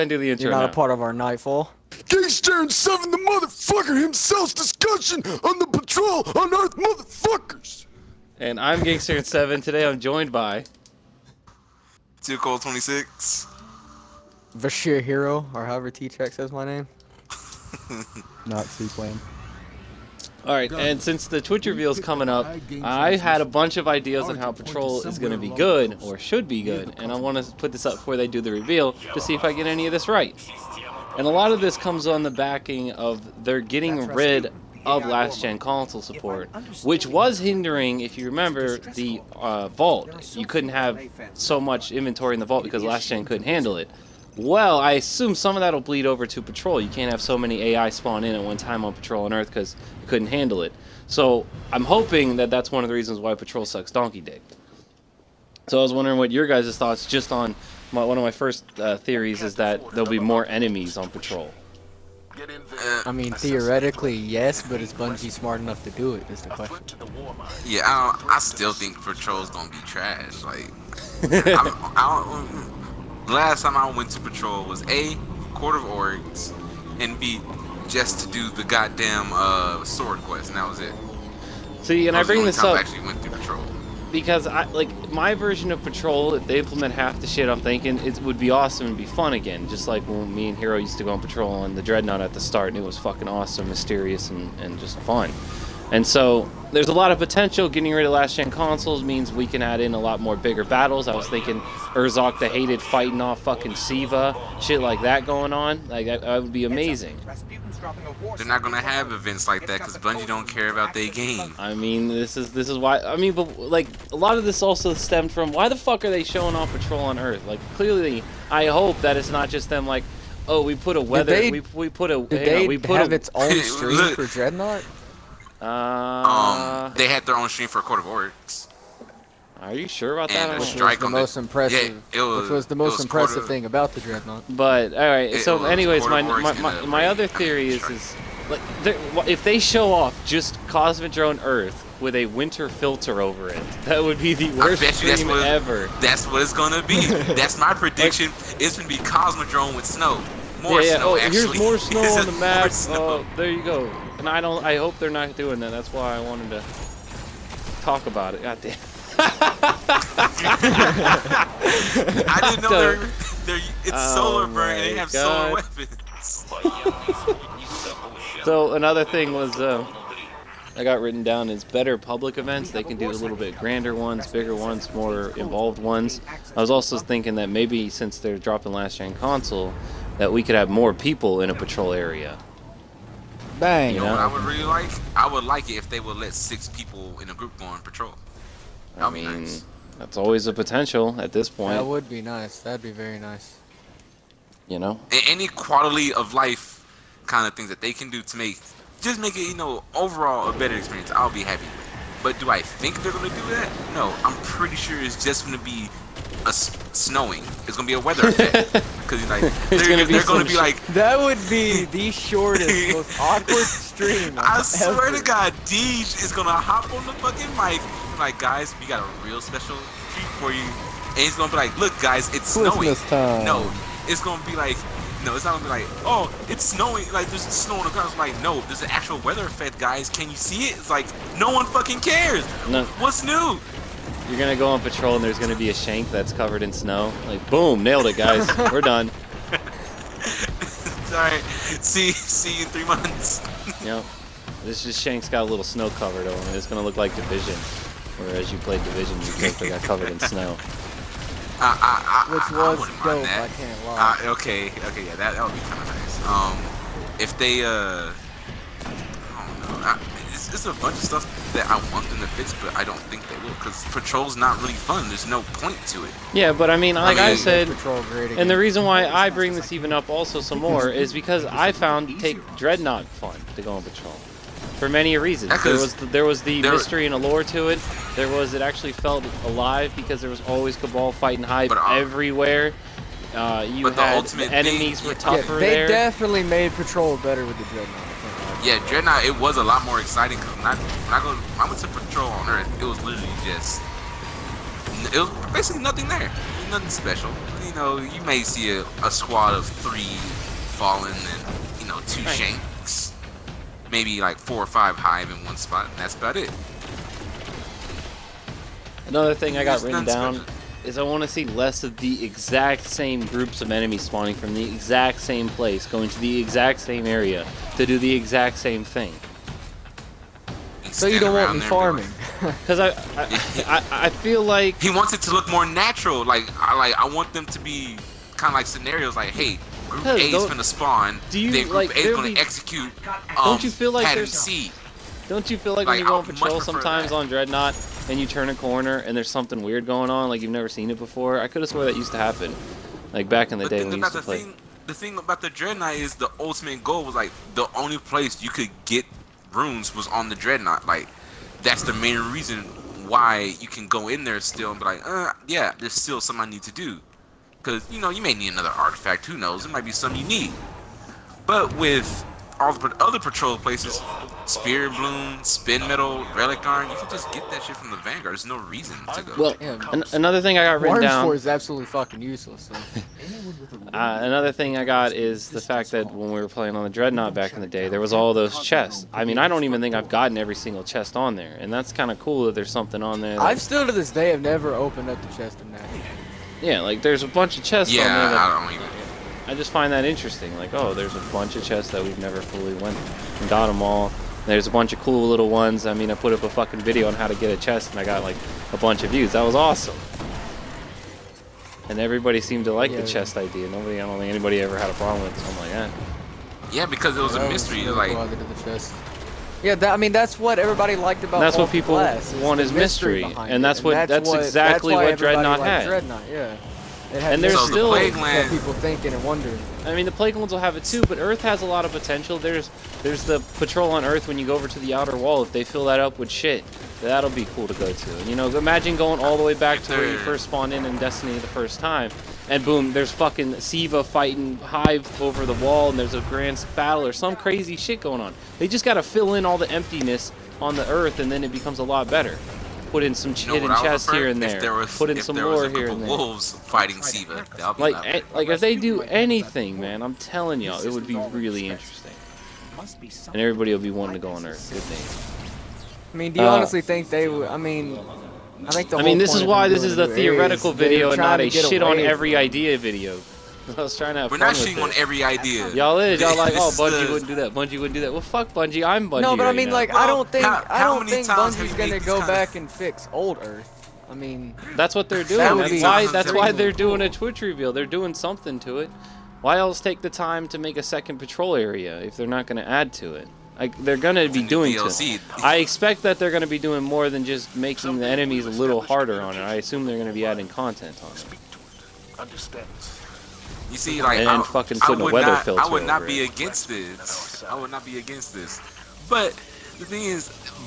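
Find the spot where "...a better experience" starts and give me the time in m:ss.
3:20.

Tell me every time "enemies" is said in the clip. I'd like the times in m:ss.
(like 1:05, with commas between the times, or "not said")
1:00, 4:44, 5:13, 8:08.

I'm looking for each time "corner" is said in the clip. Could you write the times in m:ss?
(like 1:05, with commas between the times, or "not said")
5:38.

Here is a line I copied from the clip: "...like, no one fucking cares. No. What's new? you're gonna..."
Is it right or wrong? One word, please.
right.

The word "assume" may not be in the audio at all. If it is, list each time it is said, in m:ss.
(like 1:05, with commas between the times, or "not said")
0:44, 8:09.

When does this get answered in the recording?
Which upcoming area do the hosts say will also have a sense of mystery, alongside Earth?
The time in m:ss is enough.
7:00.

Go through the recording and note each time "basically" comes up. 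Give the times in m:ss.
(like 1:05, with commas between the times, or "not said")
4:09, 4:55.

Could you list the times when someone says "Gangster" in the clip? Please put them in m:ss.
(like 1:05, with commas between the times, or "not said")
0:02, 0:08.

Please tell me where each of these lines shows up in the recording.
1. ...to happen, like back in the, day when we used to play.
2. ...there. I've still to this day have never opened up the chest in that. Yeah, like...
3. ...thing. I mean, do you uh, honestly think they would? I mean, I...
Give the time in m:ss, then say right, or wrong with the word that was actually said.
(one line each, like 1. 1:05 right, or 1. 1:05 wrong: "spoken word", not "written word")
1. 5:42 right
2. 6:23 right
3. 7:34 right.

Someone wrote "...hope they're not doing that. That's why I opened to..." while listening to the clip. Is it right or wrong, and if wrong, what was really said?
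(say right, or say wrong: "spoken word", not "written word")
wrong: "wanted", not "opened".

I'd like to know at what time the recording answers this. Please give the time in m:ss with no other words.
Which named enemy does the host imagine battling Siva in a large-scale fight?
1:41.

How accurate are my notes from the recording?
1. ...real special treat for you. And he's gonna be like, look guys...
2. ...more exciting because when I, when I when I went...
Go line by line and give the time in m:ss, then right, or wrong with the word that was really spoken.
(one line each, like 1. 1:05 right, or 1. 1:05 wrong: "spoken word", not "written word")
1. 3:39 right
2. 4:49 right.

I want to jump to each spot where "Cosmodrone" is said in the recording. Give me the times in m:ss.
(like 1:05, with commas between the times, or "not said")
2:20, 2:28.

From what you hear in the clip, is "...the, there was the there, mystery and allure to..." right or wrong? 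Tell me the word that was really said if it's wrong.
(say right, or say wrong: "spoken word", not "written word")
right.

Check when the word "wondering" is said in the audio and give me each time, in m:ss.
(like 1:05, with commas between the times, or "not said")
0:55, 6:59.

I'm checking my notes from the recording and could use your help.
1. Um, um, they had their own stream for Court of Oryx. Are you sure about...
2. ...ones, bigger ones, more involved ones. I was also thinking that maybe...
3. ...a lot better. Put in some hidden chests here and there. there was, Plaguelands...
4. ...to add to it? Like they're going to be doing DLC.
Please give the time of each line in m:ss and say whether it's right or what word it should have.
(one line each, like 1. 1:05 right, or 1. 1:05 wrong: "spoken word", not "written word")
1. 2:05 right
2. 2:53 right
3. 7:21 wrong: "Put", not "Plaguelands"
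4. 8:02 right.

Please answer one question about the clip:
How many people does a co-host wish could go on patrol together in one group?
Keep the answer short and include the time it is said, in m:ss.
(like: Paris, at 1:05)
6, at 3:06.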